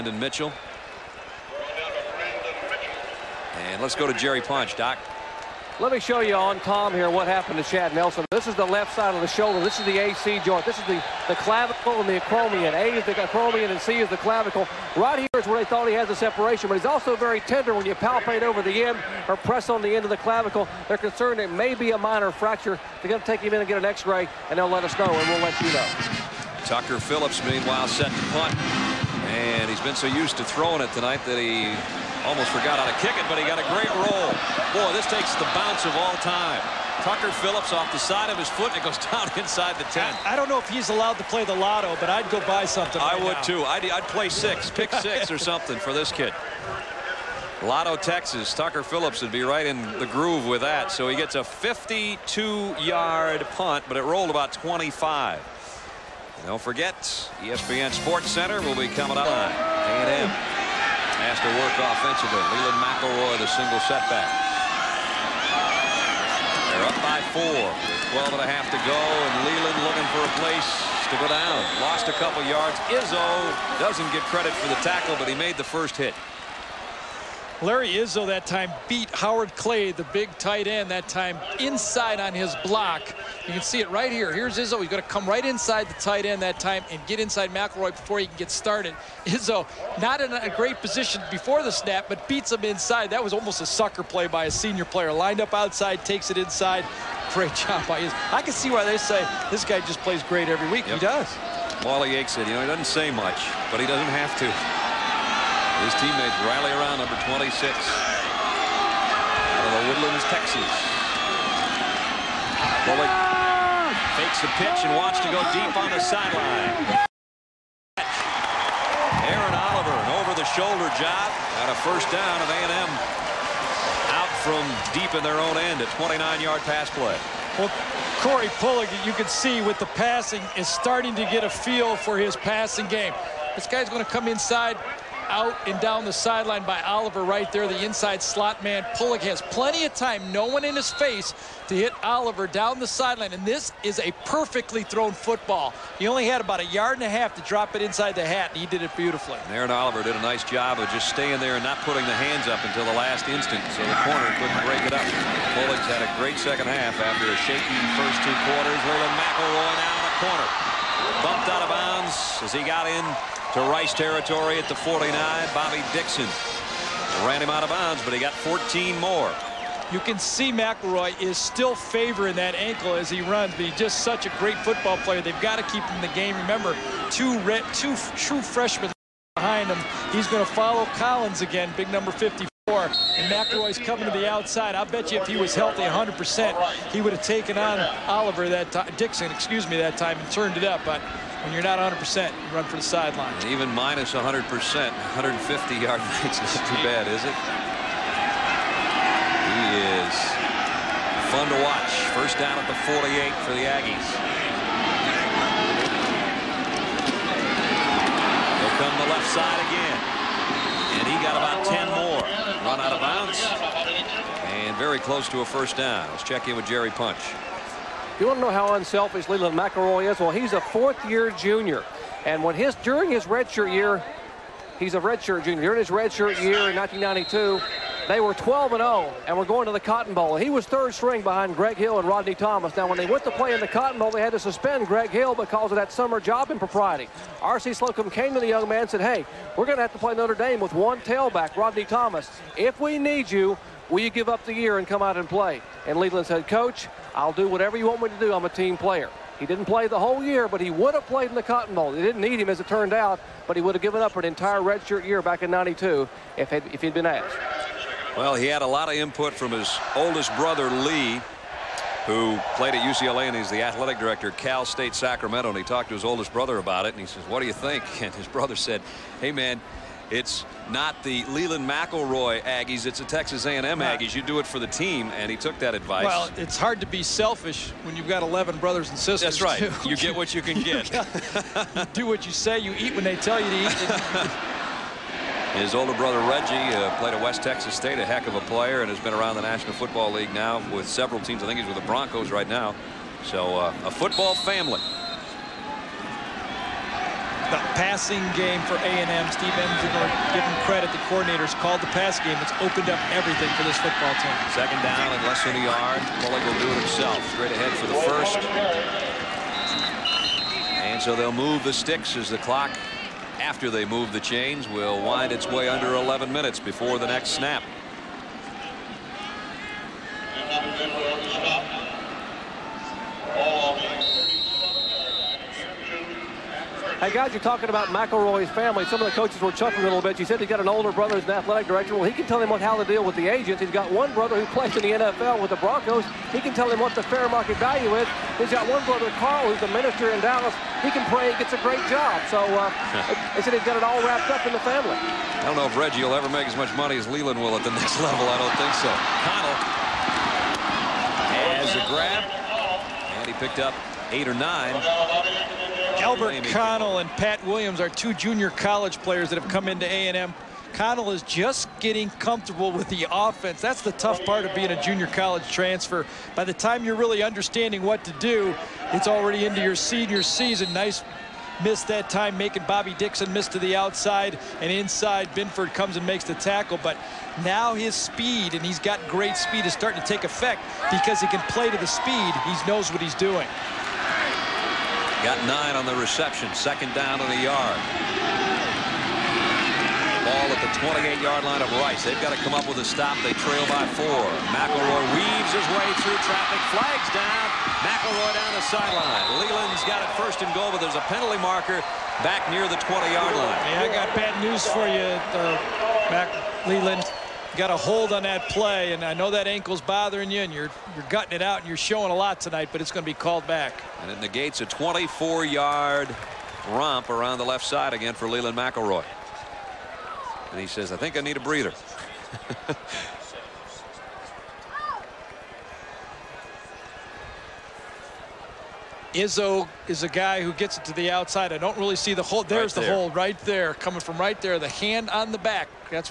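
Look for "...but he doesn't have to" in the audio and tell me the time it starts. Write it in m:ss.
1:43.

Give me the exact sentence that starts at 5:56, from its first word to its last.
Albert Connell and Pat Williams are two junior college players that have come into A&M.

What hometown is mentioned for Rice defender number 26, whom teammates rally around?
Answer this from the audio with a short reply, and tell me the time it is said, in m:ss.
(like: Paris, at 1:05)
The Woodlands, Texas, at 1:49.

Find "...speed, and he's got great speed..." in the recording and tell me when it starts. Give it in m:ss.
6:17.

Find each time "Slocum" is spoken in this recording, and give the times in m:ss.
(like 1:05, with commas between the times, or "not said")
3:57.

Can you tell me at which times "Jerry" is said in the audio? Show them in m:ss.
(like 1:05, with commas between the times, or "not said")
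0:04, 3:36.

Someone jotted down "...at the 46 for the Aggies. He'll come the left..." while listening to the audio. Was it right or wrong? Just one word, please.
wrong.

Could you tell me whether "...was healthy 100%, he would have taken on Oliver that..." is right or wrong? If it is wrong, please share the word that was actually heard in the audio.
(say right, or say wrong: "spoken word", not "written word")
right.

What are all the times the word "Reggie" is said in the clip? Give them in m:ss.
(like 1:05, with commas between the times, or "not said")
4:46, 5:45.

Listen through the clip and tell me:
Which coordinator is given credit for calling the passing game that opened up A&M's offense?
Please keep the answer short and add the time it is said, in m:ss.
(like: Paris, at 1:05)
Steve Ensminger, at 4:59.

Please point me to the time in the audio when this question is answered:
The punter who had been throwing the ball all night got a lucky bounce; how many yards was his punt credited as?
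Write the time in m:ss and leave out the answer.
0:51.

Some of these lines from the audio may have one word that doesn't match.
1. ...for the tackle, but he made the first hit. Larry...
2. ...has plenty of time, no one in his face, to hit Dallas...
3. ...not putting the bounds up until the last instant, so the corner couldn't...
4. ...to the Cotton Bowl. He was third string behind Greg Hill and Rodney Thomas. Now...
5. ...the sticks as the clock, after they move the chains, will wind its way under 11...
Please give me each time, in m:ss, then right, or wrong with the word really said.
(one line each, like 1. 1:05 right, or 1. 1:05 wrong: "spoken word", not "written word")
1. 1:14 right
2. 2:19 wrong: "Oliver", not "Dallas"
3. 2:31 wrong: "hands", not "bounds"
4. 3:49 right
5. 5:11 right.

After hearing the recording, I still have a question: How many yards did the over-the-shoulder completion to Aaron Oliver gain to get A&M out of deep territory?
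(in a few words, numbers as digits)
29.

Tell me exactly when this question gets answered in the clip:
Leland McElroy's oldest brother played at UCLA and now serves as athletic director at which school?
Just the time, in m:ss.
4:24.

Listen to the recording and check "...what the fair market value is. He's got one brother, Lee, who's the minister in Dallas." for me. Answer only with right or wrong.
wrong.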